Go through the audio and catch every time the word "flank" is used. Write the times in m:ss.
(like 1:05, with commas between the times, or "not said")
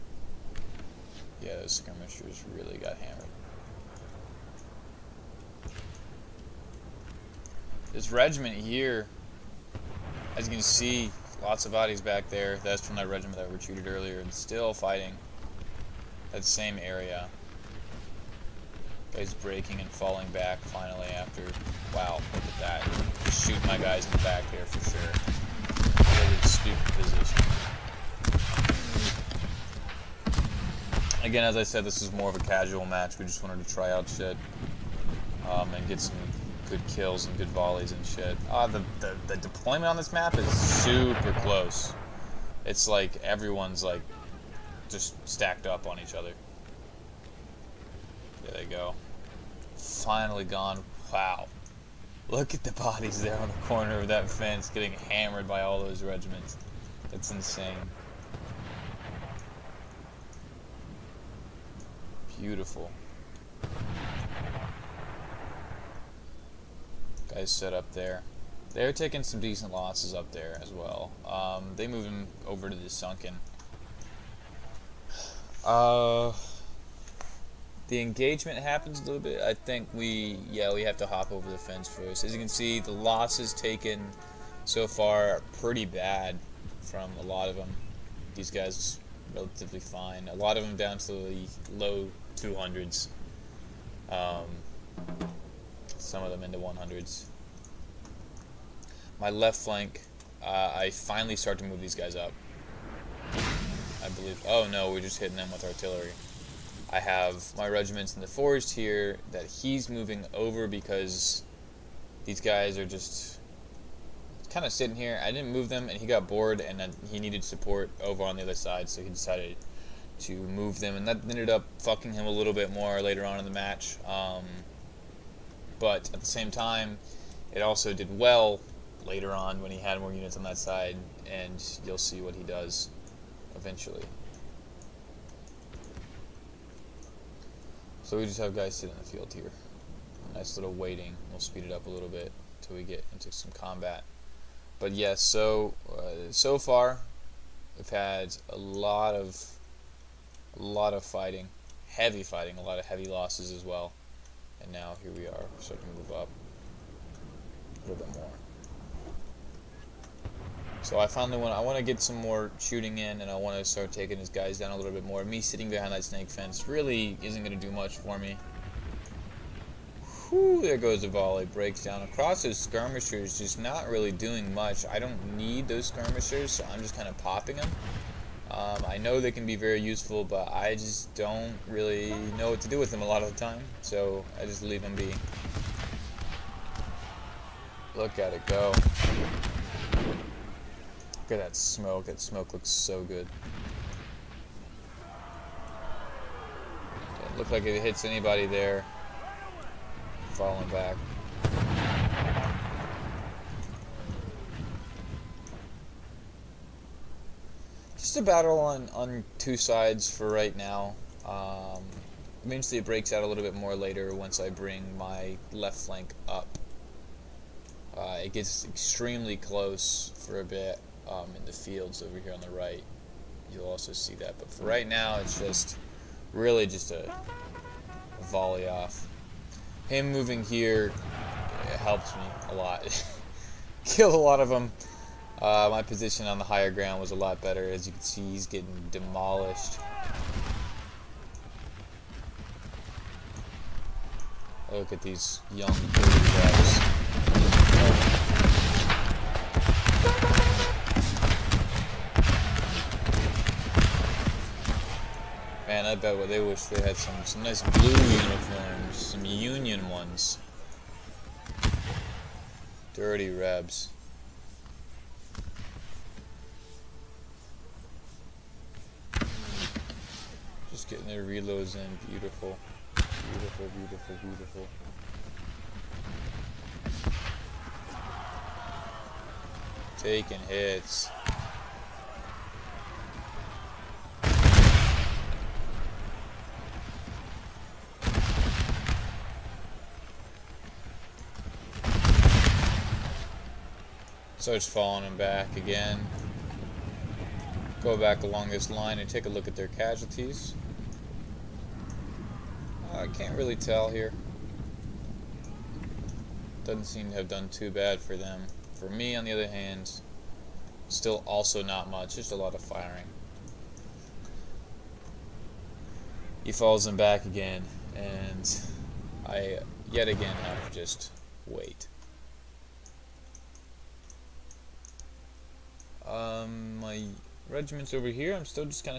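1:39, 3:35.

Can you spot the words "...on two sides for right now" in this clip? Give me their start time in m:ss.
3:28.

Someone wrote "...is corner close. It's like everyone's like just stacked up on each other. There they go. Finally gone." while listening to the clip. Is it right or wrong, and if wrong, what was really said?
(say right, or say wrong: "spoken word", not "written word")
wrong: "super", not "corner".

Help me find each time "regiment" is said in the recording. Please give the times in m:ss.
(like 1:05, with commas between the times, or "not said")
0:08, 0:13, 0:56, 1:47, 5:27.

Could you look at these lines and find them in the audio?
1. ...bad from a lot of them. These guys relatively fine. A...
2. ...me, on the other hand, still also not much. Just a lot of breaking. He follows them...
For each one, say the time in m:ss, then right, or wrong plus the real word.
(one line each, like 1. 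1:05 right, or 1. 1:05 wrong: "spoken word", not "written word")
1. 1:25 right
2. 5:08 wrong: "firing", not "breaking".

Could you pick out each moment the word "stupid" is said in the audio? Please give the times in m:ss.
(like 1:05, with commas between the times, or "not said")
0:26.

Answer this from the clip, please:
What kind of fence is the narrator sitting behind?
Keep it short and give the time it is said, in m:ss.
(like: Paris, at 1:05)
Snake fence, at 2:46.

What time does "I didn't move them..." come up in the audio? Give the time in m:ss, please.
1:55.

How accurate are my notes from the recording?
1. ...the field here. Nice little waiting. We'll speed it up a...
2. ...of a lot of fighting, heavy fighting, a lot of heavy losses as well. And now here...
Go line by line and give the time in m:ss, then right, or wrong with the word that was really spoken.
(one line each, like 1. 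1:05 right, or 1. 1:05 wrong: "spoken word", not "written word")
1. 2:19 right
2. 2:29 right.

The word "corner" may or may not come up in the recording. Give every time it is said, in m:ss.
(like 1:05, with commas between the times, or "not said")
0:53.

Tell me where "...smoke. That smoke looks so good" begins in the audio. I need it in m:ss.
3:11.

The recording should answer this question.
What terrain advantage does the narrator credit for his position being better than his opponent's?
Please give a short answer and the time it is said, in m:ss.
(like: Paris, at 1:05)
Higher ground, at 3:56.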